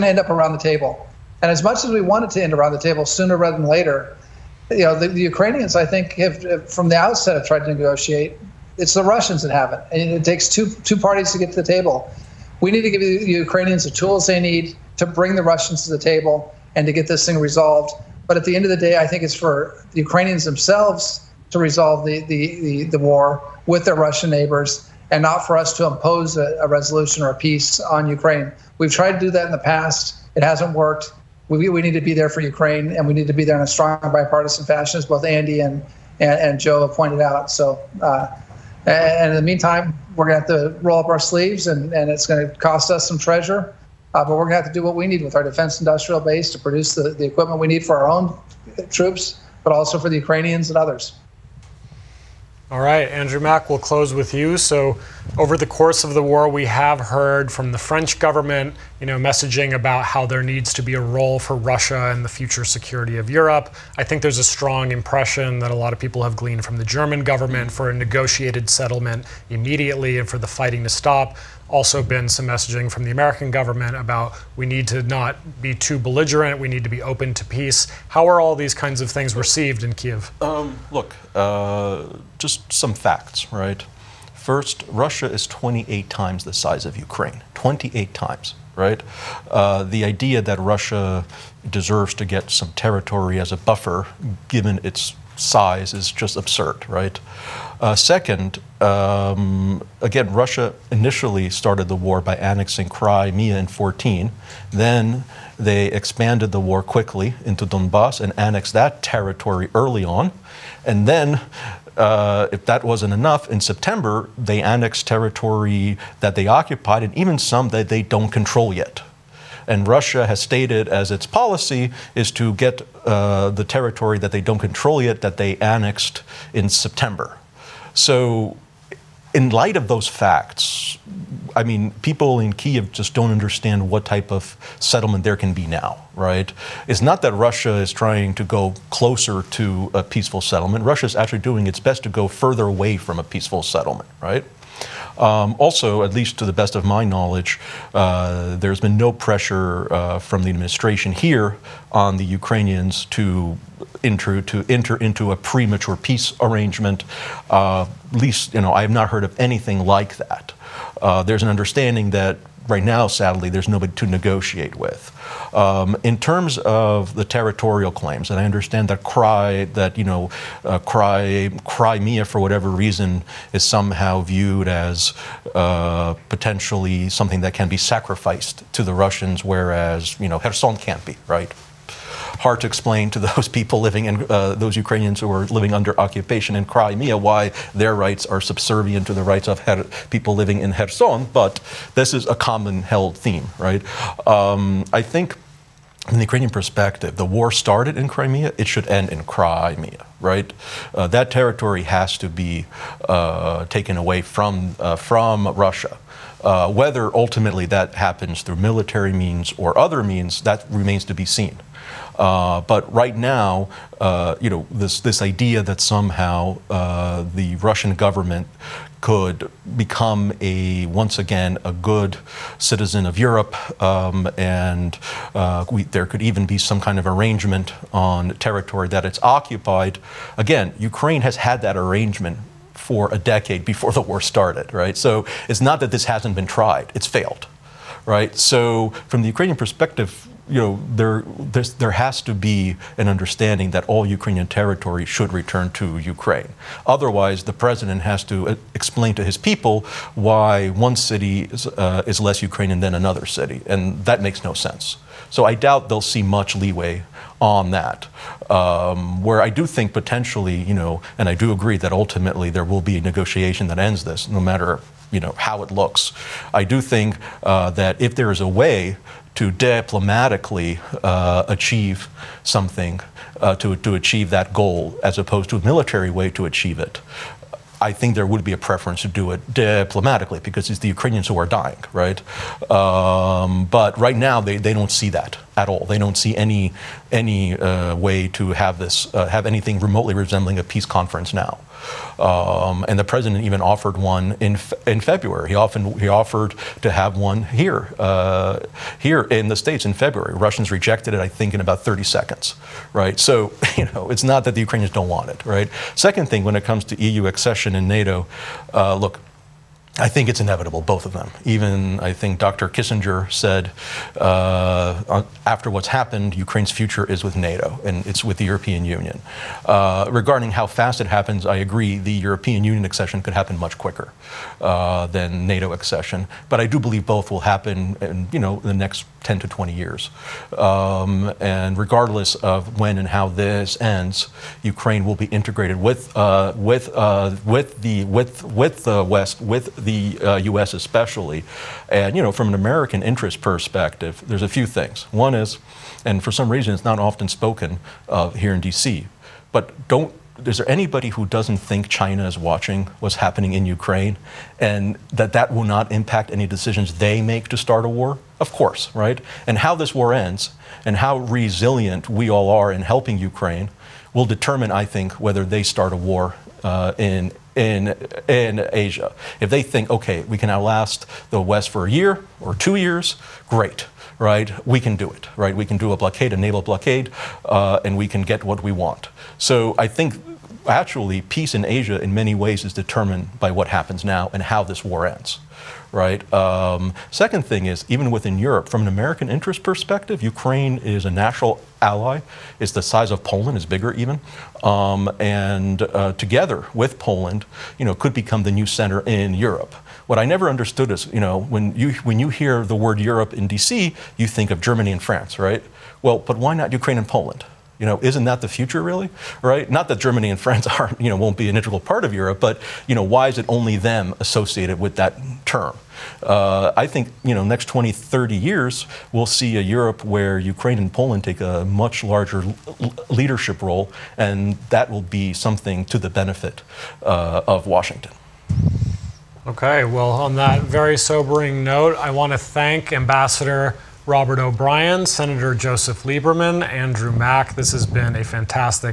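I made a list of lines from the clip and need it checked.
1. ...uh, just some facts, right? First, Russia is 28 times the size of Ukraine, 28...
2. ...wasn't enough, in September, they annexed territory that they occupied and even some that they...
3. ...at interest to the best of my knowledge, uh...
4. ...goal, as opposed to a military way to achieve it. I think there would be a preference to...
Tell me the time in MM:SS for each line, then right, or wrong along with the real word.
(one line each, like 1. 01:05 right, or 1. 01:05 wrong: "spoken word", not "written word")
1. 01:21 right
2. 01:52 right
3. 02:26 wrong: "least", not "interest"
4. 04:34 right.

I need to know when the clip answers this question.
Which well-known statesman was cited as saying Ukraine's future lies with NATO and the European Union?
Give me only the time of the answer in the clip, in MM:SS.
05:12.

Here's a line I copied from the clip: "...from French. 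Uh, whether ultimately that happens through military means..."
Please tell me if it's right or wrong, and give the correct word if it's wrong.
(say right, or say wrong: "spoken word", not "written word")
wrong: "Russia", not "French".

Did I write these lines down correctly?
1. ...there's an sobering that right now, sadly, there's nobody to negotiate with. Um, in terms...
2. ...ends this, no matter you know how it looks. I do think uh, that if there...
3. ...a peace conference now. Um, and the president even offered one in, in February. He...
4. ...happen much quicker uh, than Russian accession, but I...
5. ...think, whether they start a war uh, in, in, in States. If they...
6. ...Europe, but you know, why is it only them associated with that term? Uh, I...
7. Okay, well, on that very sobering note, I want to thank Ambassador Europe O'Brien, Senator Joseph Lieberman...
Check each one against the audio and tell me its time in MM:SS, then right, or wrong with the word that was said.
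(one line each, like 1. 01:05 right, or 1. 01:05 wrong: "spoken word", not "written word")
1. 02:41 wrong: "understanding", not "sobering"
2. 04:23 right
3. 04:50 right
4. 05:23 wrong: "NATO", not "Russian"
5. 06:04 wrong: "Asia", not "States"
6. 06:52 right
7. 07:09 wrong: "Robert", not "Europe".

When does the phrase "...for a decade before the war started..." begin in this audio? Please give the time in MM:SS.
03:52.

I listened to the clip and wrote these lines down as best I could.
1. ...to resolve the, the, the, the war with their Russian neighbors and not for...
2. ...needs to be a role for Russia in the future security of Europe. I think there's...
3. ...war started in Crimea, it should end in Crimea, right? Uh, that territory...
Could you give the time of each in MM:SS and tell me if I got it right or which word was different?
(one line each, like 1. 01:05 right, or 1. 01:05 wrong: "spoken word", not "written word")
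1. 00:21 right
2. 01:00 right
3. 03:17 right.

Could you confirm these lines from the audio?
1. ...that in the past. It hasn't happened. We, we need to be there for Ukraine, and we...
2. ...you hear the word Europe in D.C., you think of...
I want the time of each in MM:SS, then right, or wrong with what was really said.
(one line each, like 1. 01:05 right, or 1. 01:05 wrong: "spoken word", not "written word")
1. 00:29 wrong: "worked", not "happened"
2. 06:42 right.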